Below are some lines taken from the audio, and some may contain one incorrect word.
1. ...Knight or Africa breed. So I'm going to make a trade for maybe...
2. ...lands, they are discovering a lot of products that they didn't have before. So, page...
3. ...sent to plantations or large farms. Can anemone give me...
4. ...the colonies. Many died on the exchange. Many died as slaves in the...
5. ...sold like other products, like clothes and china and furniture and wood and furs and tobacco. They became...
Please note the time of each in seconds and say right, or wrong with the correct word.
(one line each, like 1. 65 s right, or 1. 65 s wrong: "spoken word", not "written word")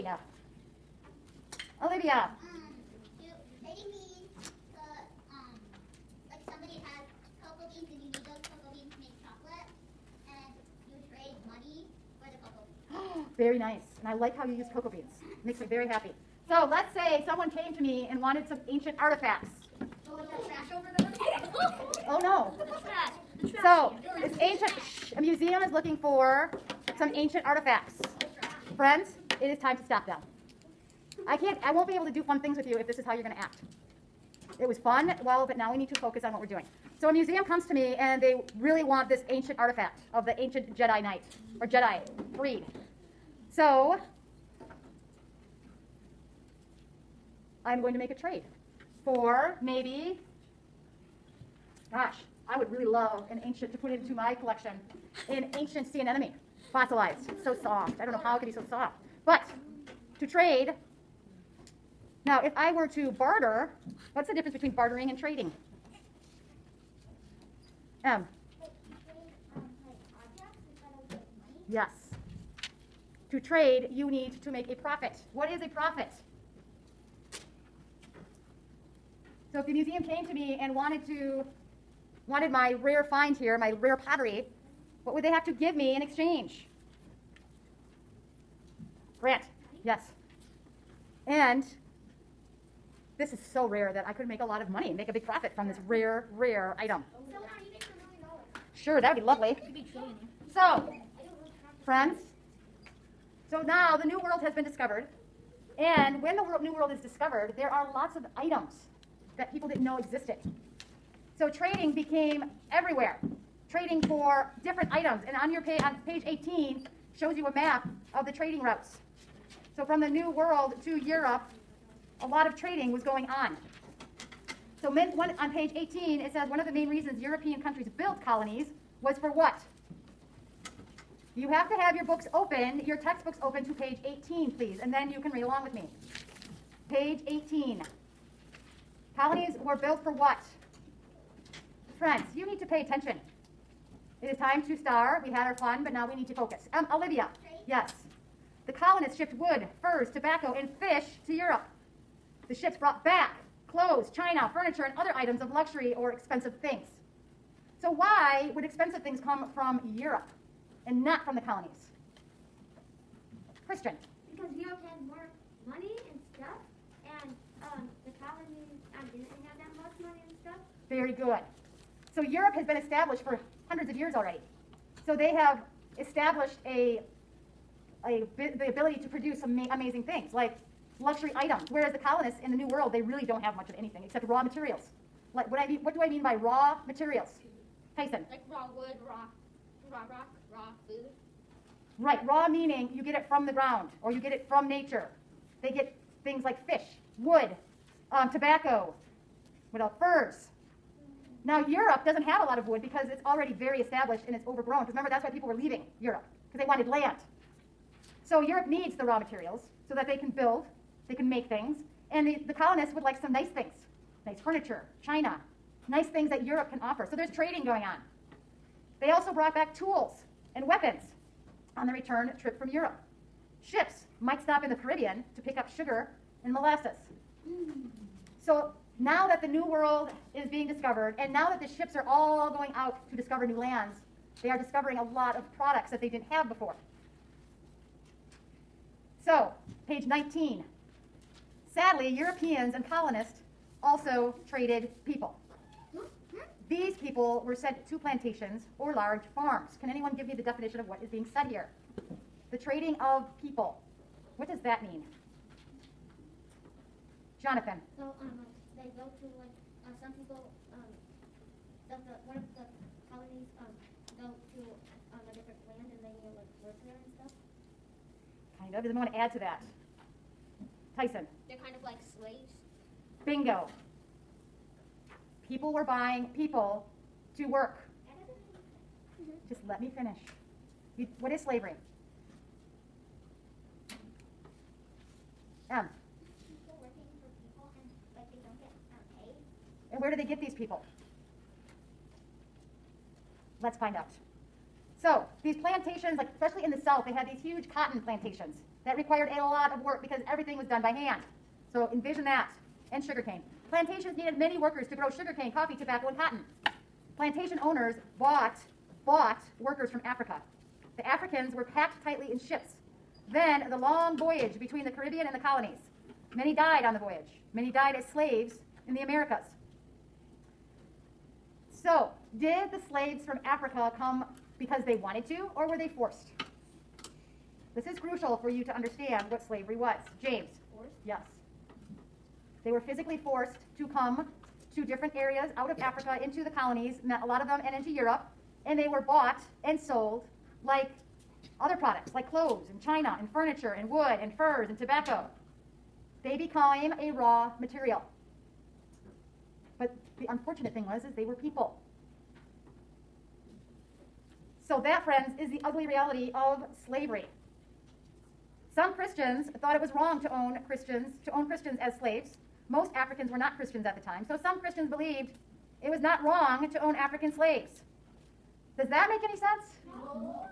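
1. 41 s wrong: "Jedi", not "Africa"
2. 233 s right
3. 247 s wrong: "anyone", not "anemone"
4. 315 s wrong: "voyage", not "exchange"
5. 339 s right.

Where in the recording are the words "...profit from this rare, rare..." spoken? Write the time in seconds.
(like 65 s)
95 s.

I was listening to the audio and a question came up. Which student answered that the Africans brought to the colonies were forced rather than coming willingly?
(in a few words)
James.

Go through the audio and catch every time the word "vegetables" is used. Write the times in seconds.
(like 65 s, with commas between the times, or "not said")
not said.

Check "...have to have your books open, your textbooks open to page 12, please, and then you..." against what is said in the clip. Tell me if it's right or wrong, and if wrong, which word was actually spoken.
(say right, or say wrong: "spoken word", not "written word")
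wrong: "18", not "12".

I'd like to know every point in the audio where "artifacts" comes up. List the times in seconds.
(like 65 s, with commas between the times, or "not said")
18 s, 27 s, 39 s.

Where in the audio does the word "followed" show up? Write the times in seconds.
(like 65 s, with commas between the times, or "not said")
not said.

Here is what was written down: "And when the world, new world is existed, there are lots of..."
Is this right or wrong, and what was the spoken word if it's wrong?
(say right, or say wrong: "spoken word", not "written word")
wrong: "discovered", not "existed".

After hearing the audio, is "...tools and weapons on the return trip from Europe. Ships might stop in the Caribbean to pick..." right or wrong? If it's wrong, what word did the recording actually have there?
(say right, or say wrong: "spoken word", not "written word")
right.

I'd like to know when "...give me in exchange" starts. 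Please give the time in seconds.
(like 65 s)
85 s.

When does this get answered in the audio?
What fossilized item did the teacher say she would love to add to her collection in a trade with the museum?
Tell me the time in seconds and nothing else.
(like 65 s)
55 s.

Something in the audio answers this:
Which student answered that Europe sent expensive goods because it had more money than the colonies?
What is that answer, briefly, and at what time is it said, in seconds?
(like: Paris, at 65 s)
Christian, at 163 s.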